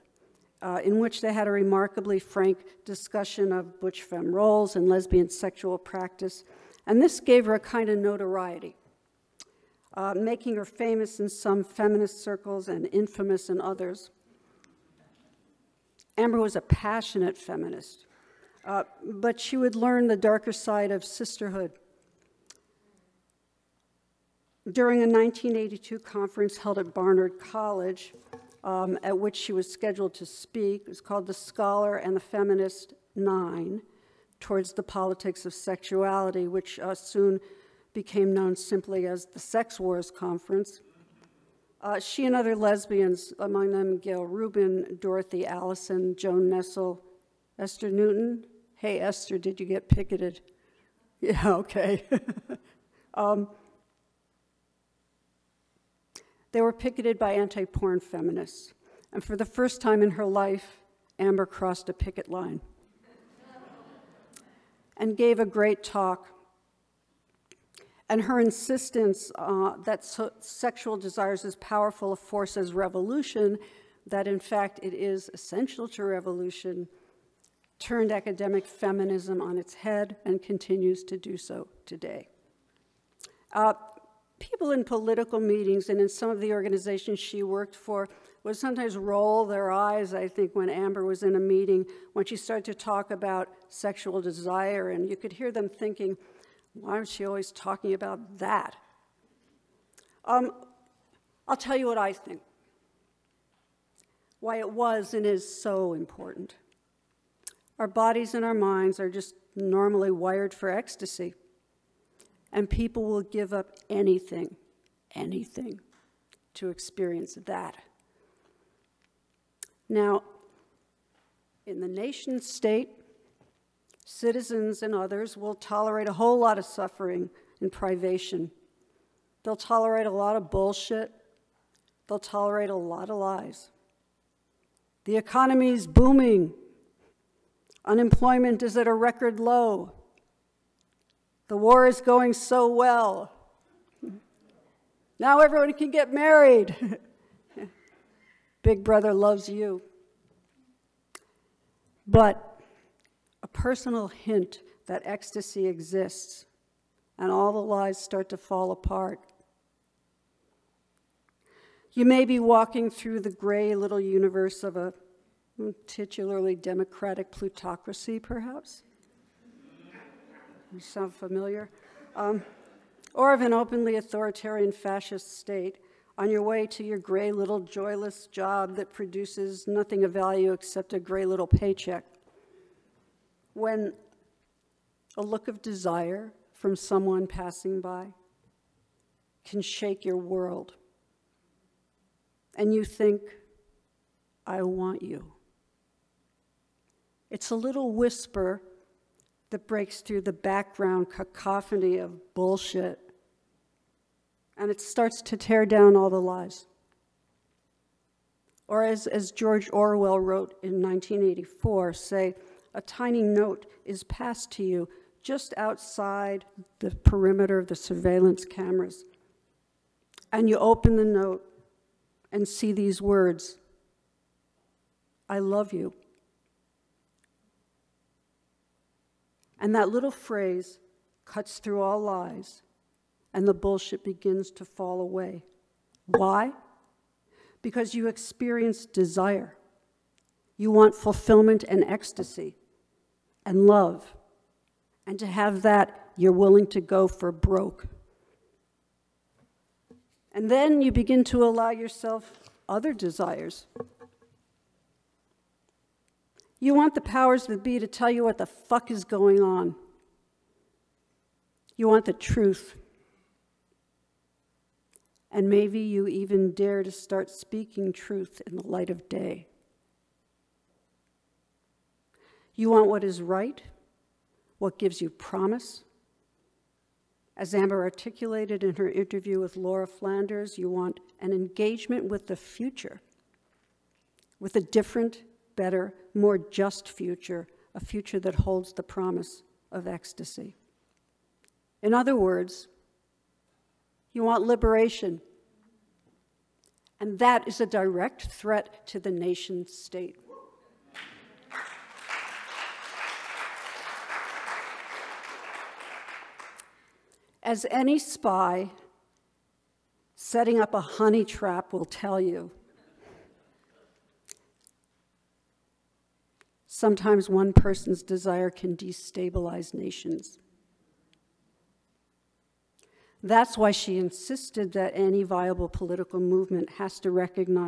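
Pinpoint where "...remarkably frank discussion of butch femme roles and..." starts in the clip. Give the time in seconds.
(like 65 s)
1 s.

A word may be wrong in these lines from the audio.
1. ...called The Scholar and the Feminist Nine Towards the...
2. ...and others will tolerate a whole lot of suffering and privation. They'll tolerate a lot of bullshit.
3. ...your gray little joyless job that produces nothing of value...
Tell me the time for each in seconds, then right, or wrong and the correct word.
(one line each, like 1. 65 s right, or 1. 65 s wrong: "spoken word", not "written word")
1. 31 s right
2. 124 s right
3. 176 s right.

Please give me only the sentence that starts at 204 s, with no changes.
And it starts to tear down all the lies.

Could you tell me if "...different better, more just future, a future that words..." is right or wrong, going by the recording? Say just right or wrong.
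wrong.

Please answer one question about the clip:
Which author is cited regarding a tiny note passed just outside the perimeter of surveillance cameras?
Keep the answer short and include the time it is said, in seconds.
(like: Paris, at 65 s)
George Orwell, at 209 s.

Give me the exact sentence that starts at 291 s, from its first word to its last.
In other words, you want liberation.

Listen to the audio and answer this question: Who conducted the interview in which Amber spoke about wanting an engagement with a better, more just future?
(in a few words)
Laura Flanders.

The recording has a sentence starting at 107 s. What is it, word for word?
Our bodies and our minds are just normally wired for ecstasy.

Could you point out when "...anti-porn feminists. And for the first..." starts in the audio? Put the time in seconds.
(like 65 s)
57 s.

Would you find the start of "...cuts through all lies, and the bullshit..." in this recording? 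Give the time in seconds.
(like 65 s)
231 s.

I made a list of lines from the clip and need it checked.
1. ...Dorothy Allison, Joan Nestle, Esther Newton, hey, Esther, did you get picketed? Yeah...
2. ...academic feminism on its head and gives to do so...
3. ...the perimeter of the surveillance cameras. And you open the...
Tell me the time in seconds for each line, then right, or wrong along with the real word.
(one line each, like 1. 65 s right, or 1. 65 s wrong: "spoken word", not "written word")
1. 44 s right
2. 78 s wrong: "continues", not "gives"
3. 216 s right.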